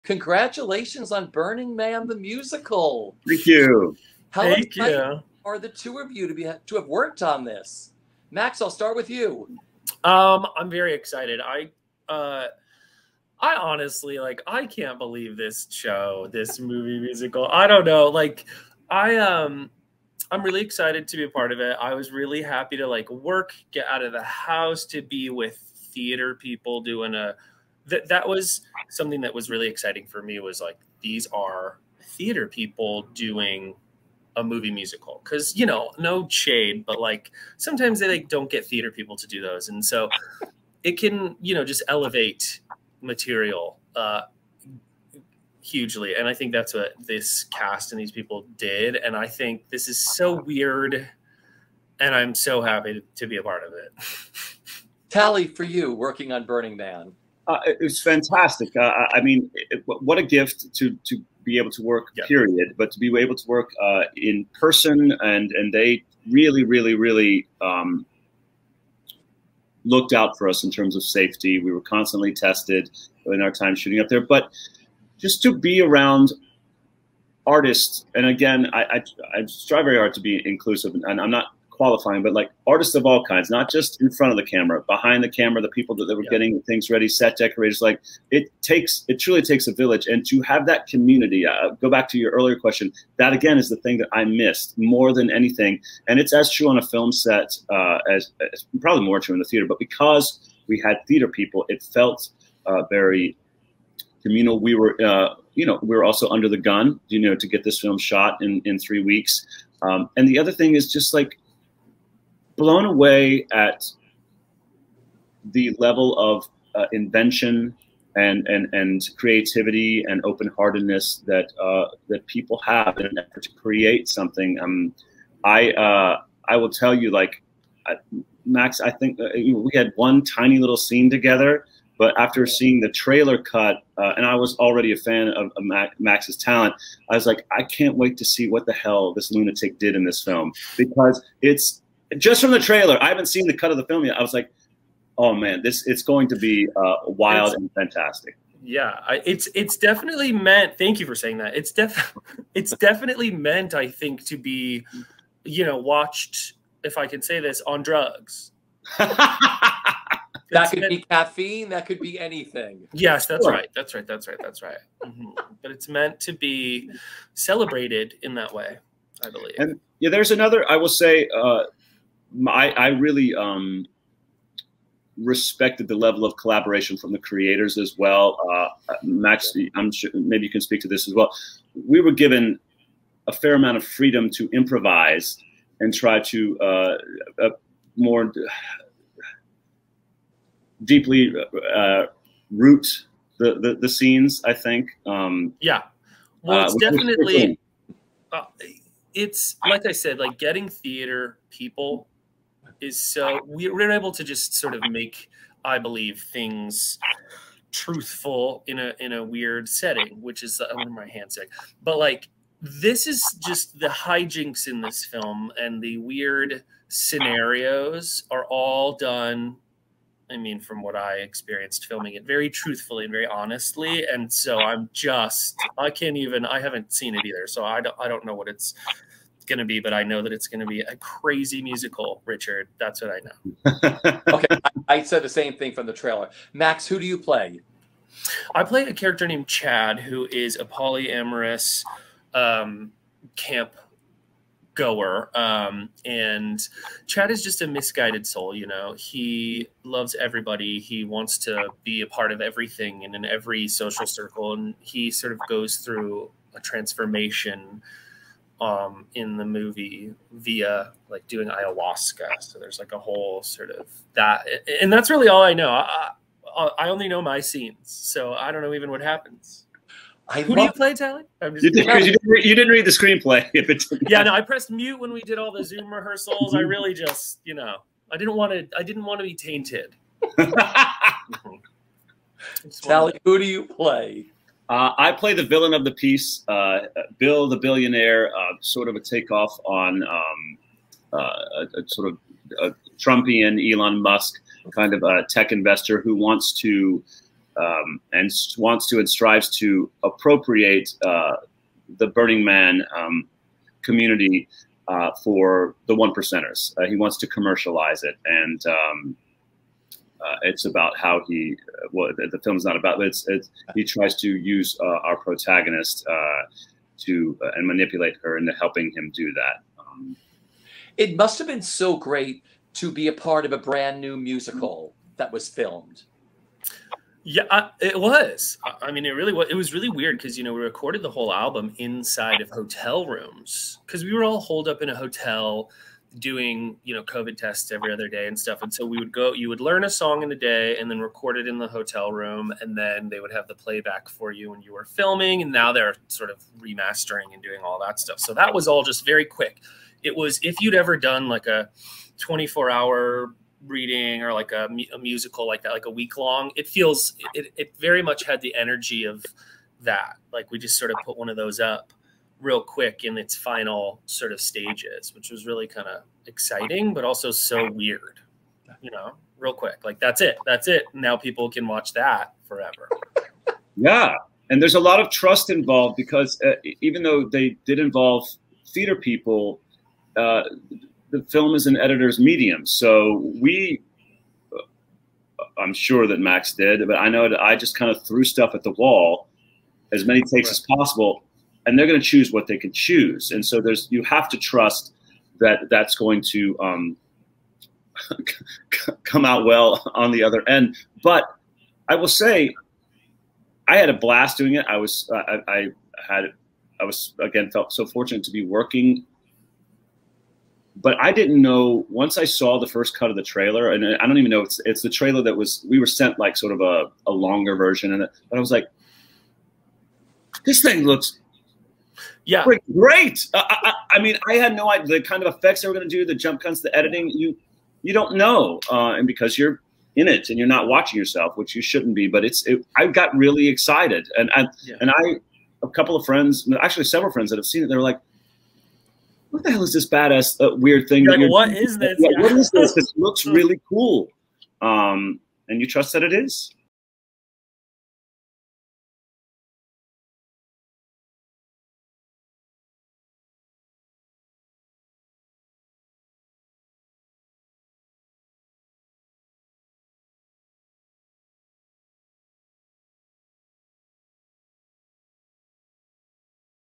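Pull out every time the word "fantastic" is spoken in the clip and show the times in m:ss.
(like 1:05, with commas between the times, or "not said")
0:58, 2:27.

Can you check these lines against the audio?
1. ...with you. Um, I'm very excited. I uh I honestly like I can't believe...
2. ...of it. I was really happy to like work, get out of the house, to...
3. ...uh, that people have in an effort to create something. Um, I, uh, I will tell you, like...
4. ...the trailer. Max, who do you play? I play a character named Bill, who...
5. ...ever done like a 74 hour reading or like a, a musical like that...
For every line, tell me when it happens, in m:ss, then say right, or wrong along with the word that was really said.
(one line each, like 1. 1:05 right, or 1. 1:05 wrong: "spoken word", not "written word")
1. 0:08 right
2. 0:21 right
3. 2:01 right
4. 3:55 wrong: "Chad", not "Bill"
5. 5:50 wrong: "24", not "74".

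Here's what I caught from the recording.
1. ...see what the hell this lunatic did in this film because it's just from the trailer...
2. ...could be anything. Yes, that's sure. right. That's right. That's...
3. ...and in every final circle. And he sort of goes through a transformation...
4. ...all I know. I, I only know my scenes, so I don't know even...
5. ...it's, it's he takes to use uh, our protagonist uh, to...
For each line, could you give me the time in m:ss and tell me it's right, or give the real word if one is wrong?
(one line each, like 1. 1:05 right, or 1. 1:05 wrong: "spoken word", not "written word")
1. 2:18 right
2. 2:41 right
3. 4:13 wrong: "social", not "final"
4. 4:25 right
5. 5:13 wrong: "tries", not "takes".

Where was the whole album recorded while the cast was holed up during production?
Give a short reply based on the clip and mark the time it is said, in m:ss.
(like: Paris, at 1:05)
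hotel rooms, at 5:32.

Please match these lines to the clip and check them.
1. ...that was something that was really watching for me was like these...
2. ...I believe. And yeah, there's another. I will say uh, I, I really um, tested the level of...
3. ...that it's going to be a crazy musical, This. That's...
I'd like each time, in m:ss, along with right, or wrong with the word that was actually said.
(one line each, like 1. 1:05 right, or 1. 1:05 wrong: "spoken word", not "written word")
1. 0:28 wrong: "exciting", not "watching"
2. 2:49 wrong: "respected", not "tested"
3. 3:50 wrong: "Richard", not "This".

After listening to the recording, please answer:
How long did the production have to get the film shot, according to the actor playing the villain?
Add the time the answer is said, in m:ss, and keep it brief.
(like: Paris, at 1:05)
3 weeks, at 1:48.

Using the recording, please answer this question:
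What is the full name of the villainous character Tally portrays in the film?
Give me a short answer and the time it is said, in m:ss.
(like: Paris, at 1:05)
Bill the billionaire, at 4:47.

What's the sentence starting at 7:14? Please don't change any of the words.
and I a couple of friends, actually several friends that have seen it, they're like.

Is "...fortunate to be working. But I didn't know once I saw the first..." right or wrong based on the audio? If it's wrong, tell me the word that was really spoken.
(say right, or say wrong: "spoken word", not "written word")
right.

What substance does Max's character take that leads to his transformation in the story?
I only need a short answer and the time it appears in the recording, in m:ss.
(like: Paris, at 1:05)
ayahuasca, at 4:21.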